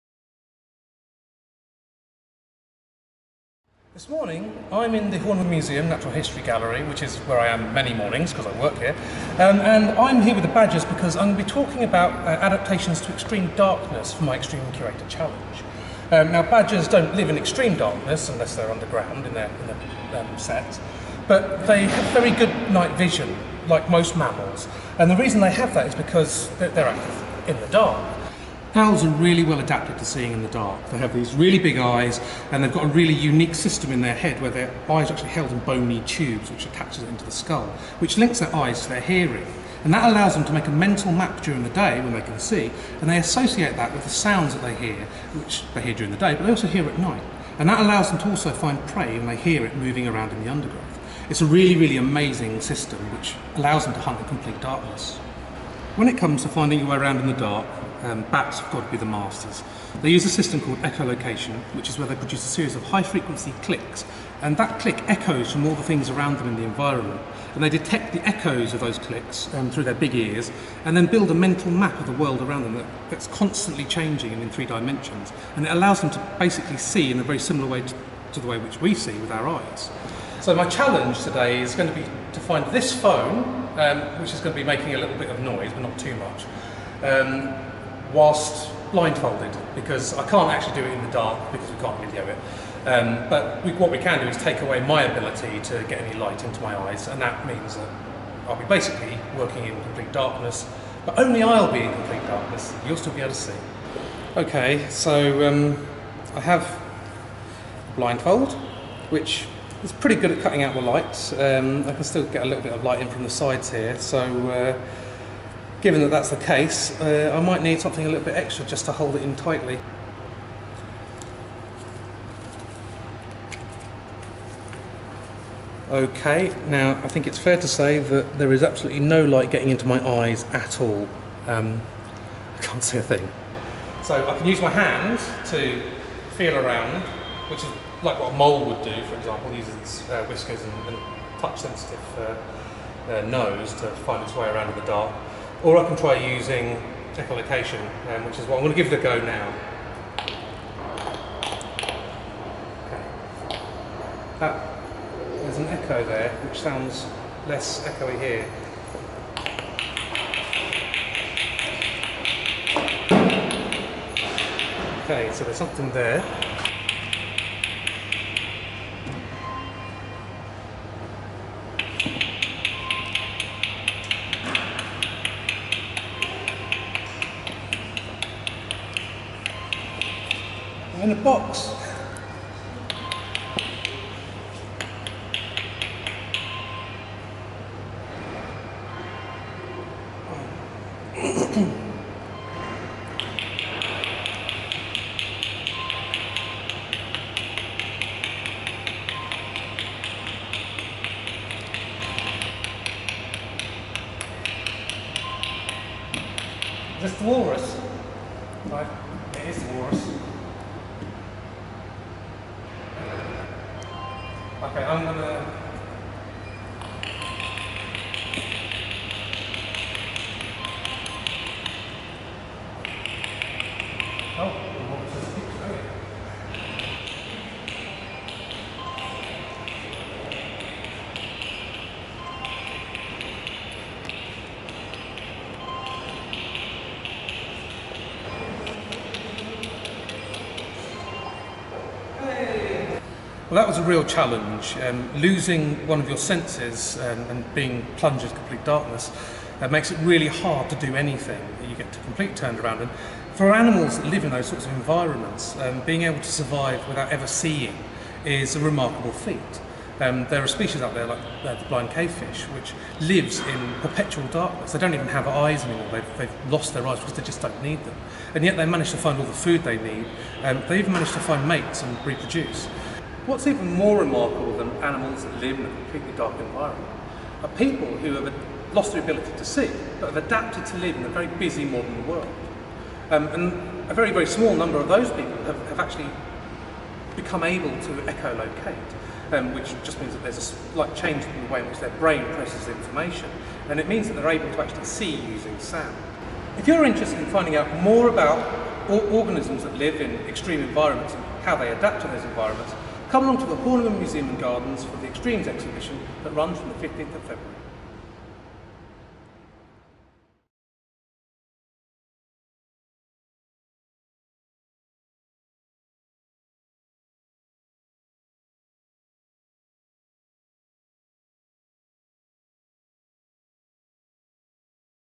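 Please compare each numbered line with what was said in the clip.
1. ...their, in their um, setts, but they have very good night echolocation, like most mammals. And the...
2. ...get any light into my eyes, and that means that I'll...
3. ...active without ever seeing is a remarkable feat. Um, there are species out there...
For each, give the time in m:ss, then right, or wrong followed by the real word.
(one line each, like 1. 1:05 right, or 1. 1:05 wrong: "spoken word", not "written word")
1. 0:19 wrong: "vision", not "echolocation"
2. 1:35 right
3. 4:16 wrong: "survive", not "active".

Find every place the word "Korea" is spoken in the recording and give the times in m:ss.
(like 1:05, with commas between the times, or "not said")
not said.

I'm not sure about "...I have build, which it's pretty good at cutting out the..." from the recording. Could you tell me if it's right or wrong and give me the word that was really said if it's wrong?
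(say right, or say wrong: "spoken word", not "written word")
wrong: "blindfold", not "build".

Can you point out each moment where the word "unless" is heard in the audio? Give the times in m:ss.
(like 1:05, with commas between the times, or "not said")
0:18.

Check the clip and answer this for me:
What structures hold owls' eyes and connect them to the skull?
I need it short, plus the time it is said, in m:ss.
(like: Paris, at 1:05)
bony tubes, at 0:35.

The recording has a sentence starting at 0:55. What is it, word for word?
When it comes to finding your way around in the dark, um, bats have got to be the masters.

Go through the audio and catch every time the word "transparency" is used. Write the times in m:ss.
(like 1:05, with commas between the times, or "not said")
not said.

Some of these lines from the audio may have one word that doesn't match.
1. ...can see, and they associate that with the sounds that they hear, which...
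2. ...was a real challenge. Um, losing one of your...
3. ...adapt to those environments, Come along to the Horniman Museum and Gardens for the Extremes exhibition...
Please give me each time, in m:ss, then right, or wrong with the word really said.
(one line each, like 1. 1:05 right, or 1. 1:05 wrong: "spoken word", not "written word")
1. 0:42 right
2. 4:03 right
3. 5:01 right.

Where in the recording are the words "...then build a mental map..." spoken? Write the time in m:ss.
1:10.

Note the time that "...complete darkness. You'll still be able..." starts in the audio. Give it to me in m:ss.
1:41.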